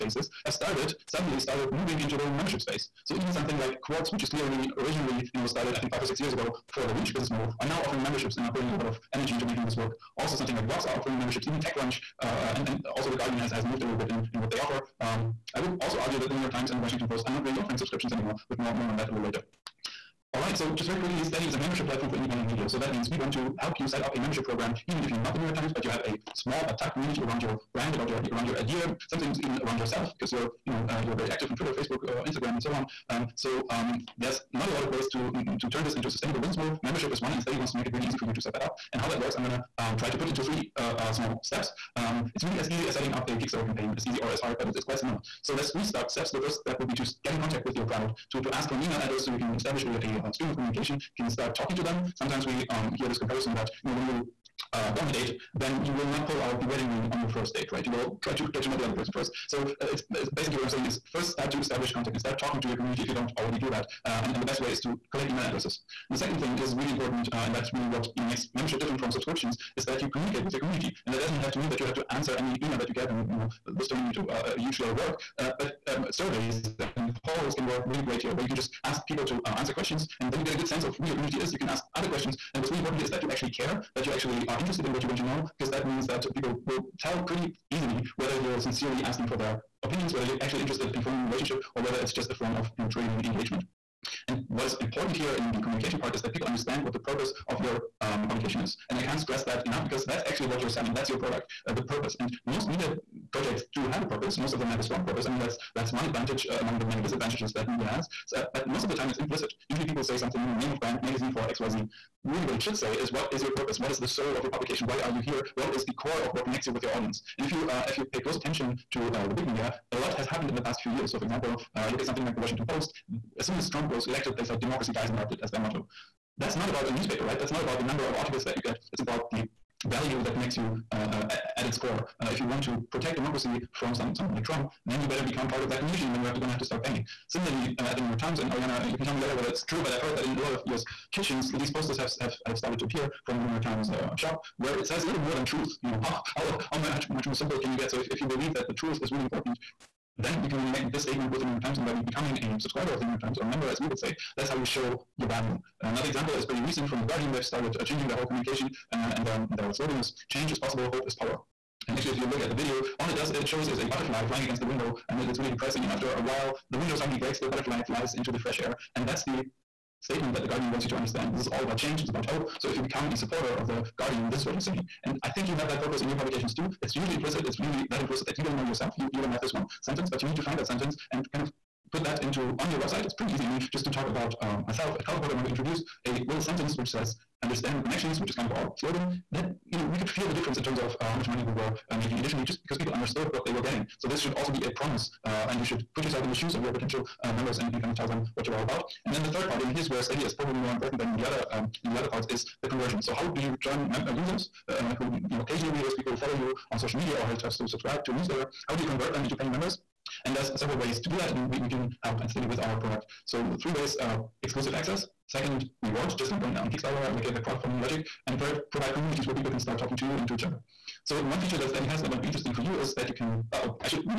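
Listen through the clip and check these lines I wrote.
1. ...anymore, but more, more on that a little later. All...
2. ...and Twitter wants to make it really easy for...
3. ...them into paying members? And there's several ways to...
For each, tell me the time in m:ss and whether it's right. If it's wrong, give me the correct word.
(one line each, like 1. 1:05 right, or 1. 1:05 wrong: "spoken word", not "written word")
1. 0:18 right
2. 0:37 wrong: "Steady", not "Twitter"
3. 3:29 right.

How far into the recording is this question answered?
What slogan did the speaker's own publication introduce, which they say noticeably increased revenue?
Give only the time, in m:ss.
3:07.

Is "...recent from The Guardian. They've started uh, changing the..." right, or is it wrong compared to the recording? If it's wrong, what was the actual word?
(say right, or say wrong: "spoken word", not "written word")
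right.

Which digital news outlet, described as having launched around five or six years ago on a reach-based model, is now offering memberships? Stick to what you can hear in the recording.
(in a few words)
Quartz.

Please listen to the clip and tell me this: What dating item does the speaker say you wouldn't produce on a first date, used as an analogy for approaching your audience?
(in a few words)
the wedding ring.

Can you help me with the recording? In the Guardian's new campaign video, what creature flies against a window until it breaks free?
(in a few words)
a butterfly.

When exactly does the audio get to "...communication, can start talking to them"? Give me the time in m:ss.
0:50.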